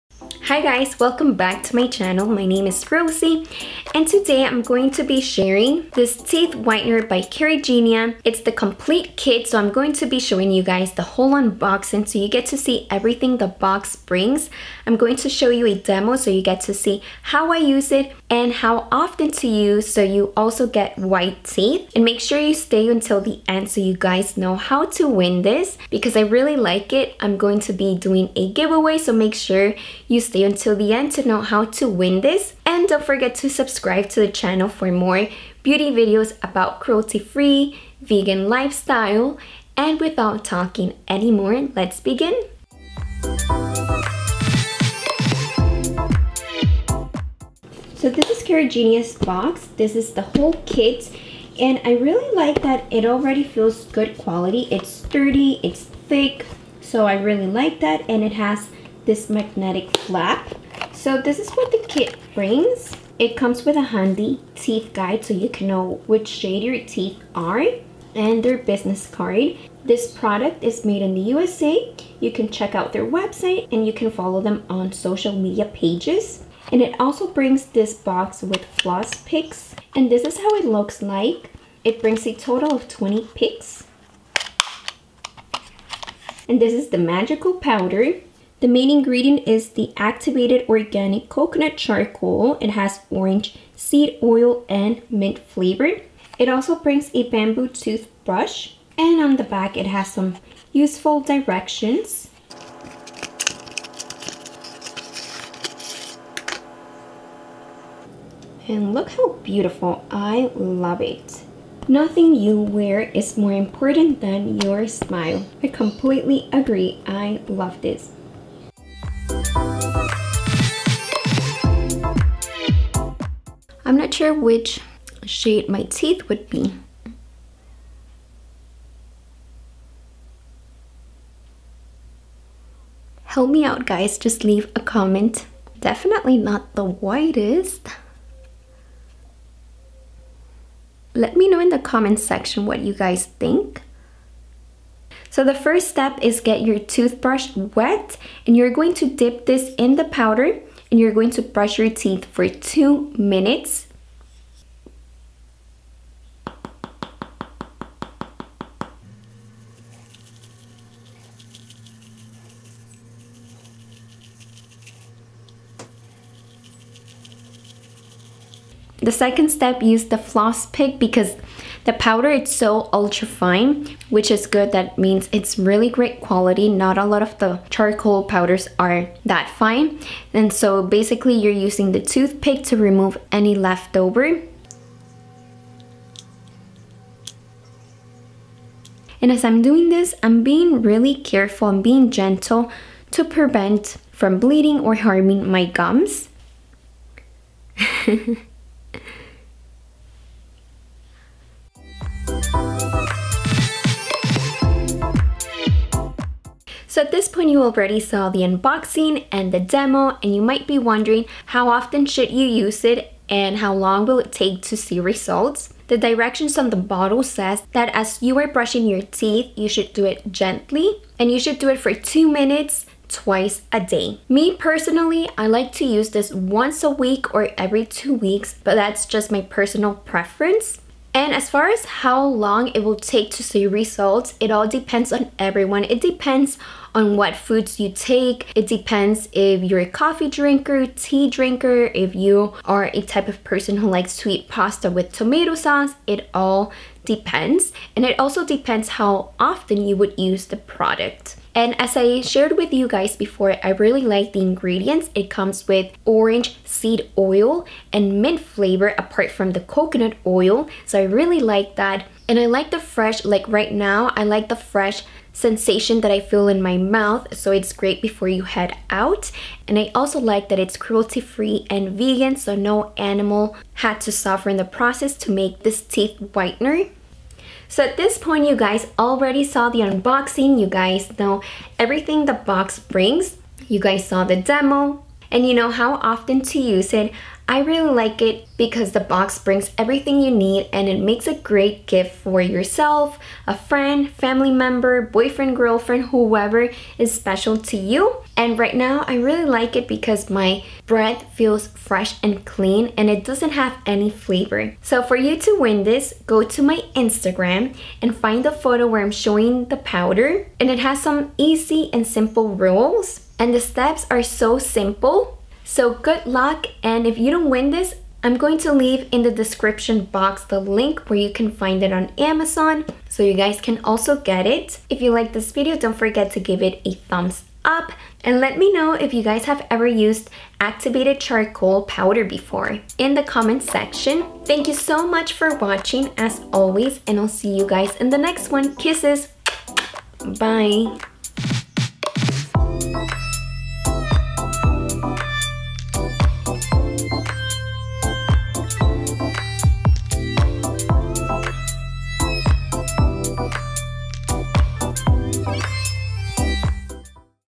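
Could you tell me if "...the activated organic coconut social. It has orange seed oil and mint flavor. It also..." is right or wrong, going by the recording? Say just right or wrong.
wrong.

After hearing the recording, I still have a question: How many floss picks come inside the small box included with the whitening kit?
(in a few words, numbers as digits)
20.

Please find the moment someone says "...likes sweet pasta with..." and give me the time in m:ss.
4:03.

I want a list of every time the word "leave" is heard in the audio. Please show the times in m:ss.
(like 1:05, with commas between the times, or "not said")
2:14, 5:18.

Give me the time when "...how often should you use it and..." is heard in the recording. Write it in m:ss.
3:31.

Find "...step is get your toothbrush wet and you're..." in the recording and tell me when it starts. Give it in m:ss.
2:25.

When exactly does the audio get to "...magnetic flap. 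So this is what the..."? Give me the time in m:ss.
0:59.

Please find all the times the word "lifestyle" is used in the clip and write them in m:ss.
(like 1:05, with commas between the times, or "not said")
0:38.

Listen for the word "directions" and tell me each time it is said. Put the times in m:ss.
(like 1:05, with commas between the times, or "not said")
1:41, 3:35.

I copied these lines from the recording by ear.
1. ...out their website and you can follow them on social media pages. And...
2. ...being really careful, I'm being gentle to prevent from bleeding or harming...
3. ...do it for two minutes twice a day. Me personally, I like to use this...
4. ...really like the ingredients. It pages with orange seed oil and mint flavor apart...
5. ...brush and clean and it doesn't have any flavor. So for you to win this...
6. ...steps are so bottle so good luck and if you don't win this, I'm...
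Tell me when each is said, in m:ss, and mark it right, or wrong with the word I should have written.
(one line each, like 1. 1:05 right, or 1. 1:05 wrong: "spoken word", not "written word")
1. 1:12 right
2. 3:10 right
3. 3:41 right
4. 4:13 wrong: "comes", not "pages"
5. 5:01 wrong: "fresh", not "brush"
6. 5:13 wrong: "simple", not "bottle".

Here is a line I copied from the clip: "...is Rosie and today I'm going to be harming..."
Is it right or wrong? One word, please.
wrong.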